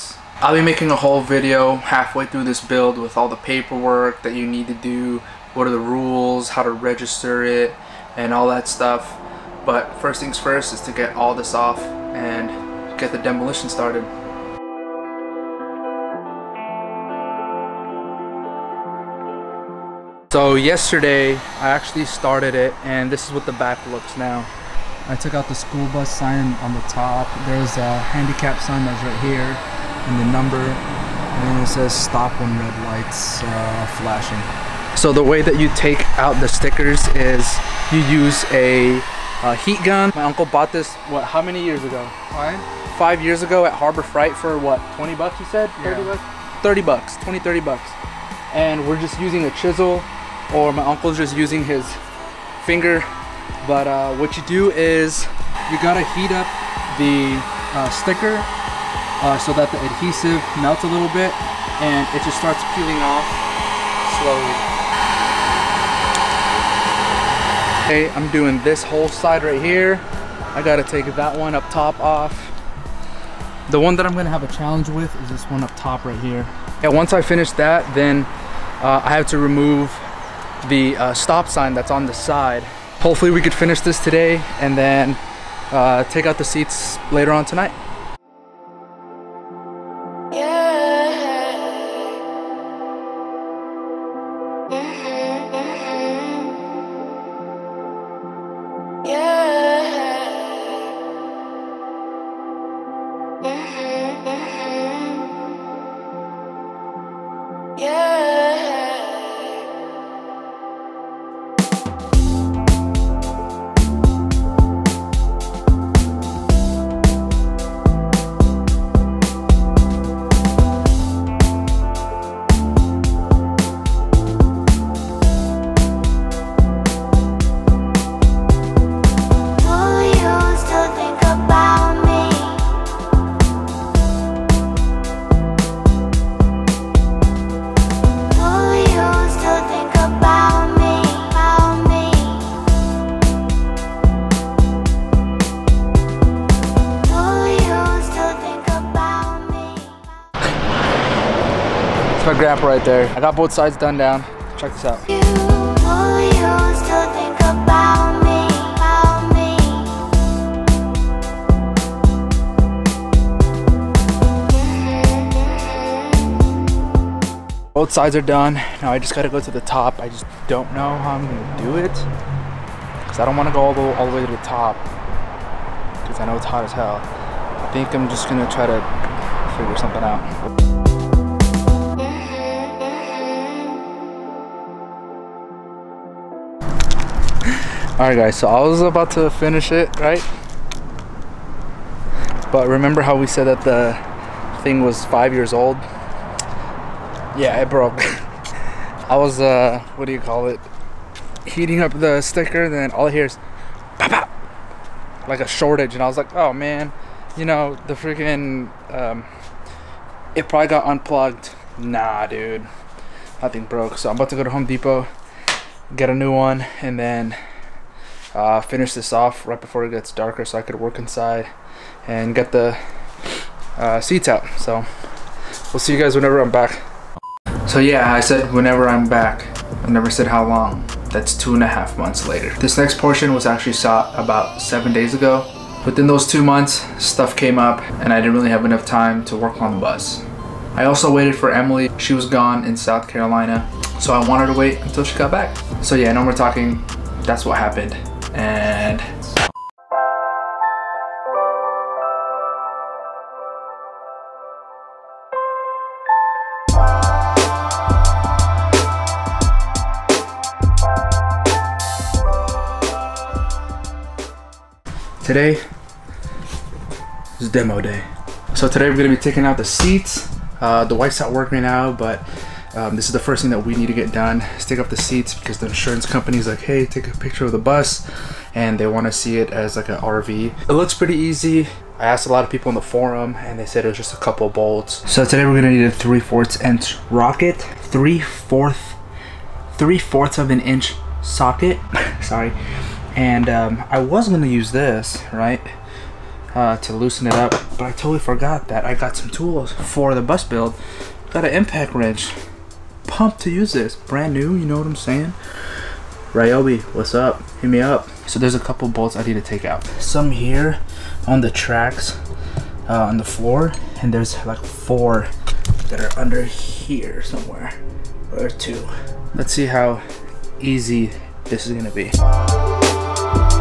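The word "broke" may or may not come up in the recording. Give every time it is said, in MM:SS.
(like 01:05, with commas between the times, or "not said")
03:17, 03:33.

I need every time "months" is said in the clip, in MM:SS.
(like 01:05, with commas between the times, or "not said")
03:51, 03:56.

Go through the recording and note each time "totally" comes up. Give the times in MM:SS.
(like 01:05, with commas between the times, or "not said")
04:57.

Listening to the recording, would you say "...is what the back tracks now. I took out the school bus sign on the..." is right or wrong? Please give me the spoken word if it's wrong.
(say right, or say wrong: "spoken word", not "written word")
wrong: "looks", not "tracks".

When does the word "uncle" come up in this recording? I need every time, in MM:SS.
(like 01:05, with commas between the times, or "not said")
00:40, 00:50.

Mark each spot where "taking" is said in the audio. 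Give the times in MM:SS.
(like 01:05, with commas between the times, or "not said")
04:29.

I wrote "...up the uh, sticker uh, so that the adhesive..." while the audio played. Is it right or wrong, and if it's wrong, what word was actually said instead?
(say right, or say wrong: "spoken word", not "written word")
right.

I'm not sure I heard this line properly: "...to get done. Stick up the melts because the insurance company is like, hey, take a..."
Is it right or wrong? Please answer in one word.
wrong.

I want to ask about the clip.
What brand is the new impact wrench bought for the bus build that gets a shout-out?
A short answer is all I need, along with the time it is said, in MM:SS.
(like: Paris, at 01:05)
Ryobi, at 05:06.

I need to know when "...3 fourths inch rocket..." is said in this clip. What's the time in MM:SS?
04:45.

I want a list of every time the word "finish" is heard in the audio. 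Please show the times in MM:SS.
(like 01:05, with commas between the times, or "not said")
01:17, 01:23, 03:09, 03:38.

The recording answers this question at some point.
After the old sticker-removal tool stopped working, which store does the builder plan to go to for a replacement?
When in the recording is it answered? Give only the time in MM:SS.
03:34.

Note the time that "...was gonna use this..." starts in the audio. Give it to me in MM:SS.
04:53.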